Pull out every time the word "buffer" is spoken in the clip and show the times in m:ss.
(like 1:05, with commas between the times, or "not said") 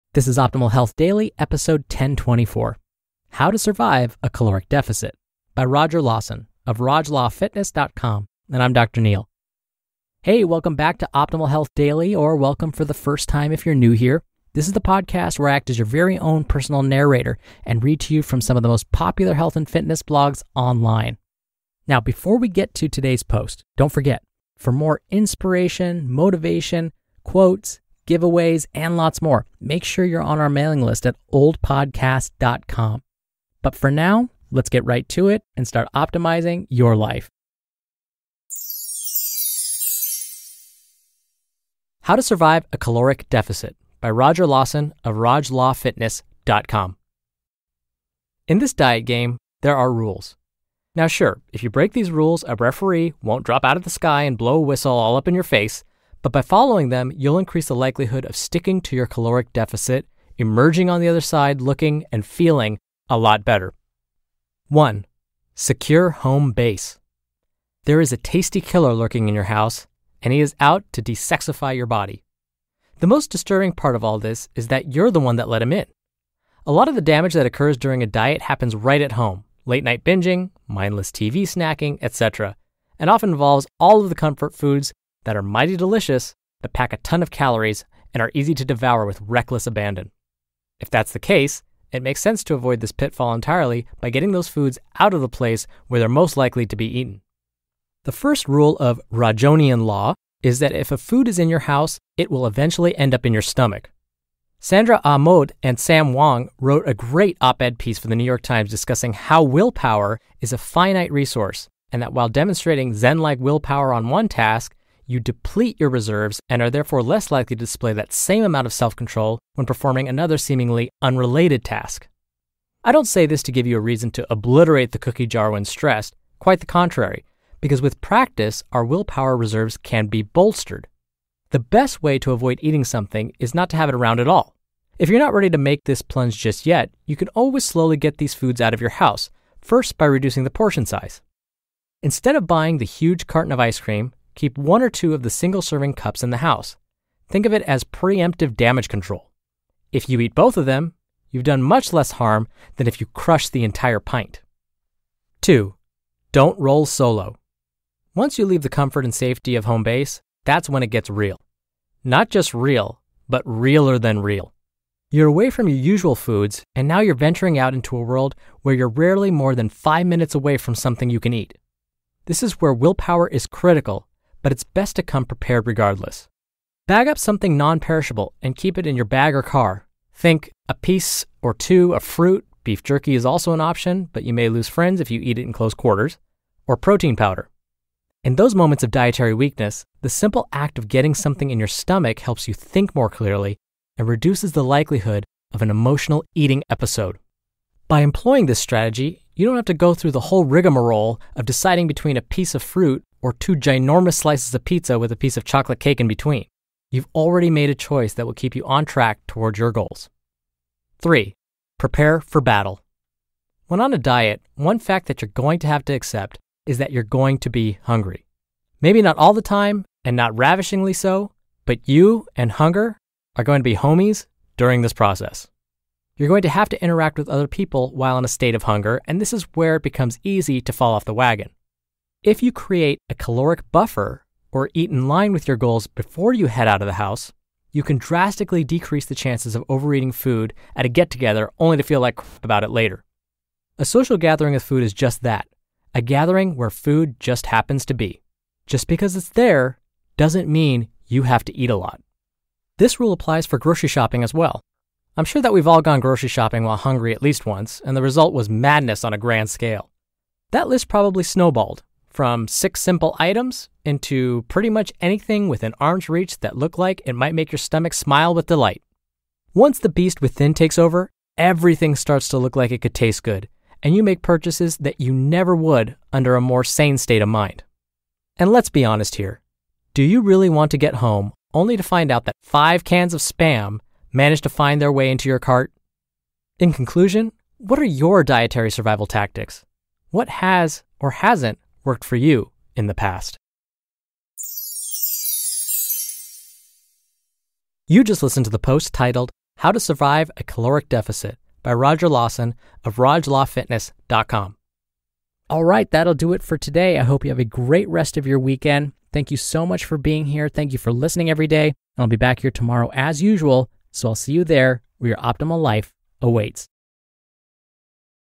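3:53.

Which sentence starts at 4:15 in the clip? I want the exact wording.
I'm sure that we've all gone grocery shopping while hungry at least once, and the result was madness on a grand scale.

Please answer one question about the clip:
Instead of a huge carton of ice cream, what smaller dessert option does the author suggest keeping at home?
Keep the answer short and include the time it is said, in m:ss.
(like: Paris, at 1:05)
single serving cups, at 2:25.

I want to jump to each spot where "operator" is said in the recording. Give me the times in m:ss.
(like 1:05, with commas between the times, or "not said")
not said.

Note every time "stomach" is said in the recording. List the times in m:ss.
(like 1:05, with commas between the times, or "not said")
1:43, 3:11, 4:27.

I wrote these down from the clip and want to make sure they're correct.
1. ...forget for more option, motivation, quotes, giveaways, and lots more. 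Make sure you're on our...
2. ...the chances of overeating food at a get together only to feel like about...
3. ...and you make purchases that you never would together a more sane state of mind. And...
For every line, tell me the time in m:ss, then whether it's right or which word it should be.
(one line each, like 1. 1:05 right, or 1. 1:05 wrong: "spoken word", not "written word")
1. 0:23 wrong: "inspiration", not "option"
2. 3:59 right
3. 4:33 wrong: "under", not "together".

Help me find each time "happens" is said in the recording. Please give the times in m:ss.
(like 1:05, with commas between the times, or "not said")
1:18, 4:07.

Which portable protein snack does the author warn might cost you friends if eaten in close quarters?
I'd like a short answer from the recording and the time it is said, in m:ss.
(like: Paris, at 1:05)
Beef jerky, at 3:02.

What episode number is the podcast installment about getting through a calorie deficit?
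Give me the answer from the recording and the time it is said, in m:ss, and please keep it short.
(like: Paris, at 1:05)
1024, at 0:01.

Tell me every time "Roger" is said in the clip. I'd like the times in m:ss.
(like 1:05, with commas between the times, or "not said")
0:05, 0:44, 5:01.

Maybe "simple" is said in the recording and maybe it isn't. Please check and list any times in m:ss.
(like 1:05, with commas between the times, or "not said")
3:10, 4:22.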